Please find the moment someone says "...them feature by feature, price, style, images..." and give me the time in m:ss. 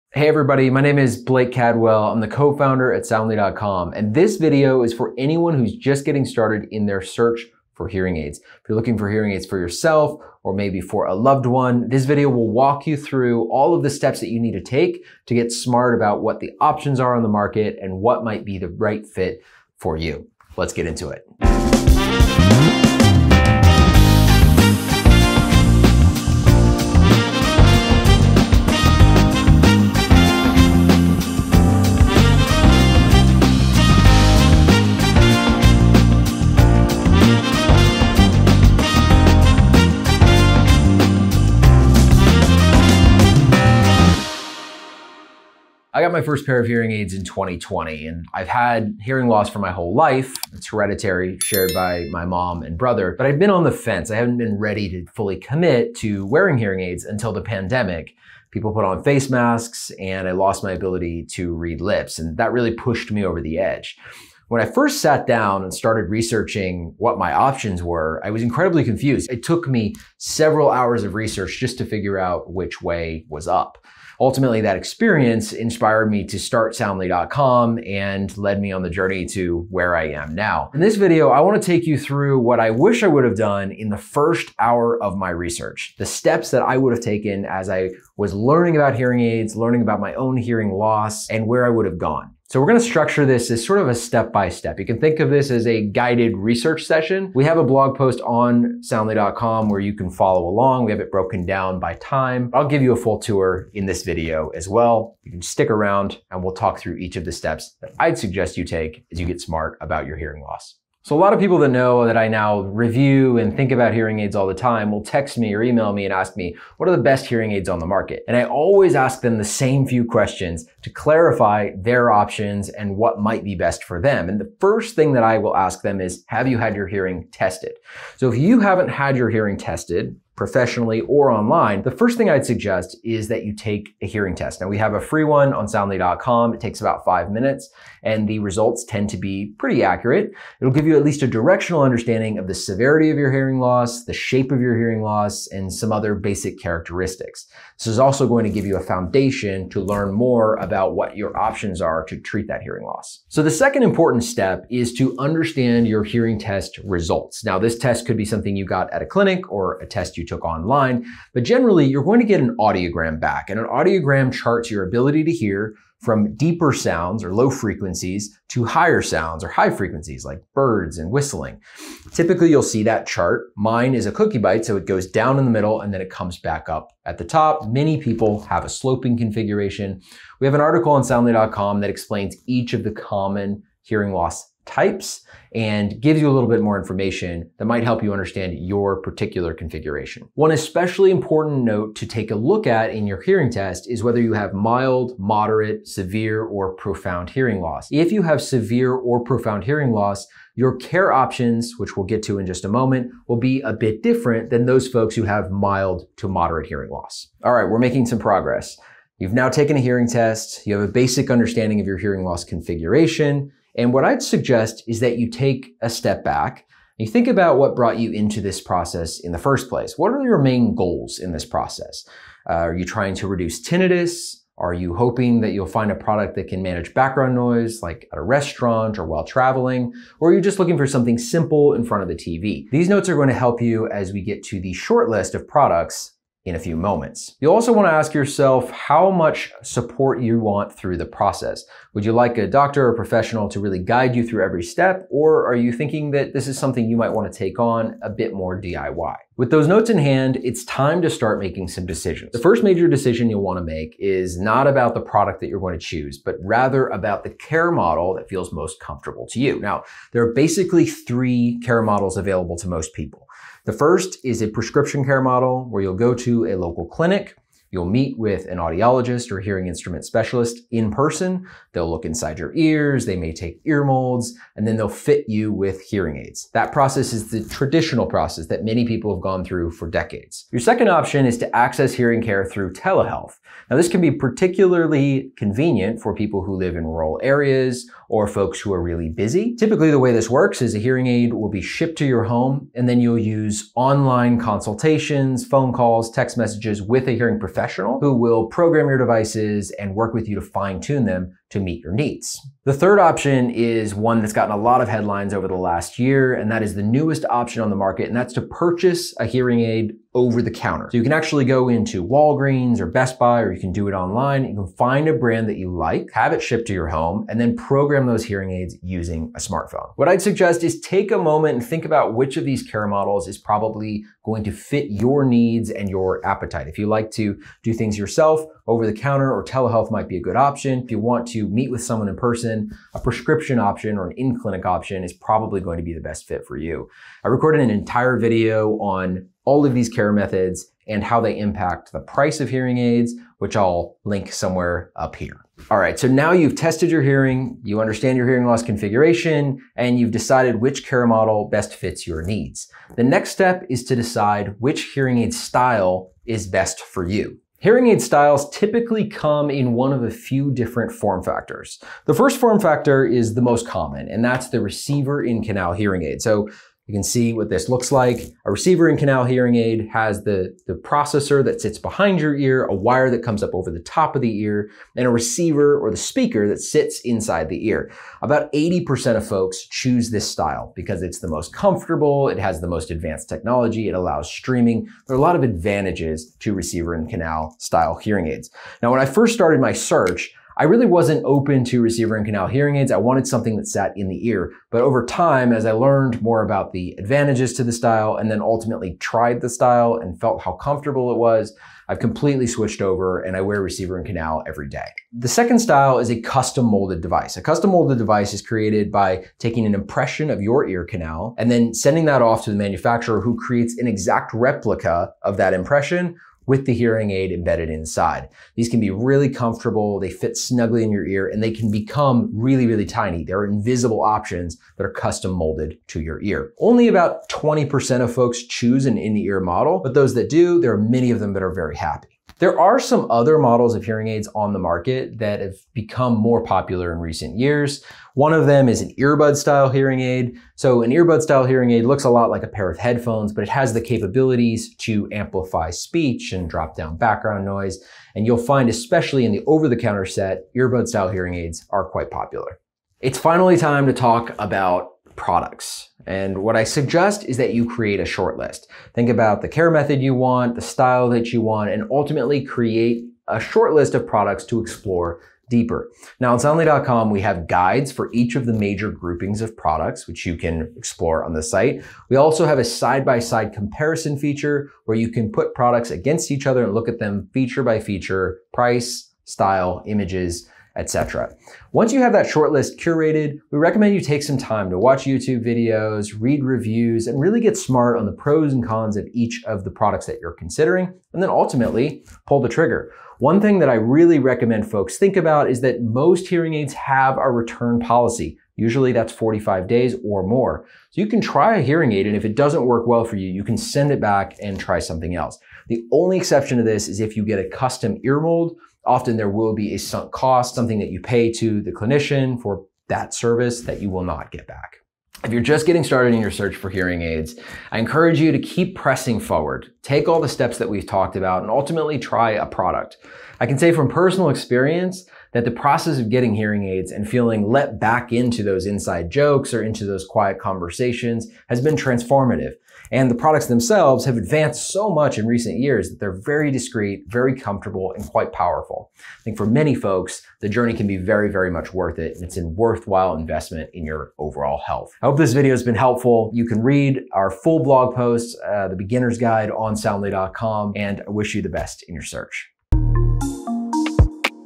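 7:56.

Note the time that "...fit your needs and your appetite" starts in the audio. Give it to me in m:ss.
5:24.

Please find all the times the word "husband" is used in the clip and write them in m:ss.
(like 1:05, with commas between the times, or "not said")
not said.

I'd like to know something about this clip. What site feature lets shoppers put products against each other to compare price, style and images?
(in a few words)
side-by-side comparison.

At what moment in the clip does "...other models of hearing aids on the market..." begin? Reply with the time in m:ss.
7:13.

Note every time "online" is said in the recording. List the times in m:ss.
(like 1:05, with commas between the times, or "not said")
2:11, 2:40, 4:53, 5:13.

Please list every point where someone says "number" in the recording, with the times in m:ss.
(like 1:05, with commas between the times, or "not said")
not said.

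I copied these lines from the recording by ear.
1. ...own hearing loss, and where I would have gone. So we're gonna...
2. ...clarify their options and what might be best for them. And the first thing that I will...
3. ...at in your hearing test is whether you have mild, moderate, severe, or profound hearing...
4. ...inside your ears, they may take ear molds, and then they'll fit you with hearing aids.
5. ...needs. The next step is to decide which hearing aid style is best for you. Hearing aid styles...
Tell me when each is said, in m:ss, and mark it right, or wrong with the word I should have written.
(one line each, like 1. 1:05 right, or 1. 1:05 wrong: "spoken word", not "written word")
1. 1:30 right
2. 2:00 right
3. 3:12 right
4. 4:32 right
5. 5:52 right.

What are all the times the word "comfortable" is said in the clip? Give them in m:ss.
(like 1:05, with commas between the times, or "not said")
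4:18, 6:21, 6:40, 6:59, 8:57.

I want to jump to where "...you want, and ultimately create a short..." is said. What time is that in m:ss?
7:41.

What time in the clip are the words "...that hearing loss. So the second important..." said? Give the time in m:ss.
2:32.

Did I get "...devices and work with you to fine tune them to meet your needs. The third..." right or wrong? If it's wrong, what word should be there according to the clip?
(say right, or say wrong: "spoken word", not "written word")
right.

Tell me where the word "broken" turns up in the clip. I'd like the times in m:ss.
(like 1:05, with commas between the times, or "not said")
1:41.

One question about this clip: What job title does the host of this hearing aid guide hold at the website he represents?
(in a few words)
co-founder.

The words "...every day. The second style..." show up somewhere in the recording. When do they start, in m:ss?
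6:44.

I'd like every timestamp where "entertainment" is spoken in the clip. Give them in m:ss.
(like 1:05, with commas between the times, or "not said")
not said.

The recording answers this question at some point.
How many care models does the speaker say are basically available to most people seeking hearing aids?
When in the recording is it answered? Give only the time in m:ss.
4:20.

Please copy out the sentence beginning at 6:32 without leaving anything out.
I wanted something that sat in the ear.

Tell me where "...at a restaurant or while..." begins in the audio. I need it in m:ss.
3:48.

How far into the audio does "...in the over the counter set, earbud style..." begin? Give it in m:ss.
7:29.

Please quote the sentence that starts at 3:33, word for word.
And what I'd suggest is that you take a step back.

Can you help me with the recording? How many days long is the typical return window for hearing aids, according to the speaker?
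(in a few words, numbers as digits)
45 days.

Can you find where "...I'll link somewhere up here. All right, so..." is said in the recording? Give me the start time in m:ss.
5:43.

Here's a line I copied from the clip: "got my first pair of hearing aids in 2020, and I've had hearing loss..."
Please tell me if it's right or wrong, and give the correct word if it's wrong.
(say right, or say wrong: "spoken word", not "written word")
right.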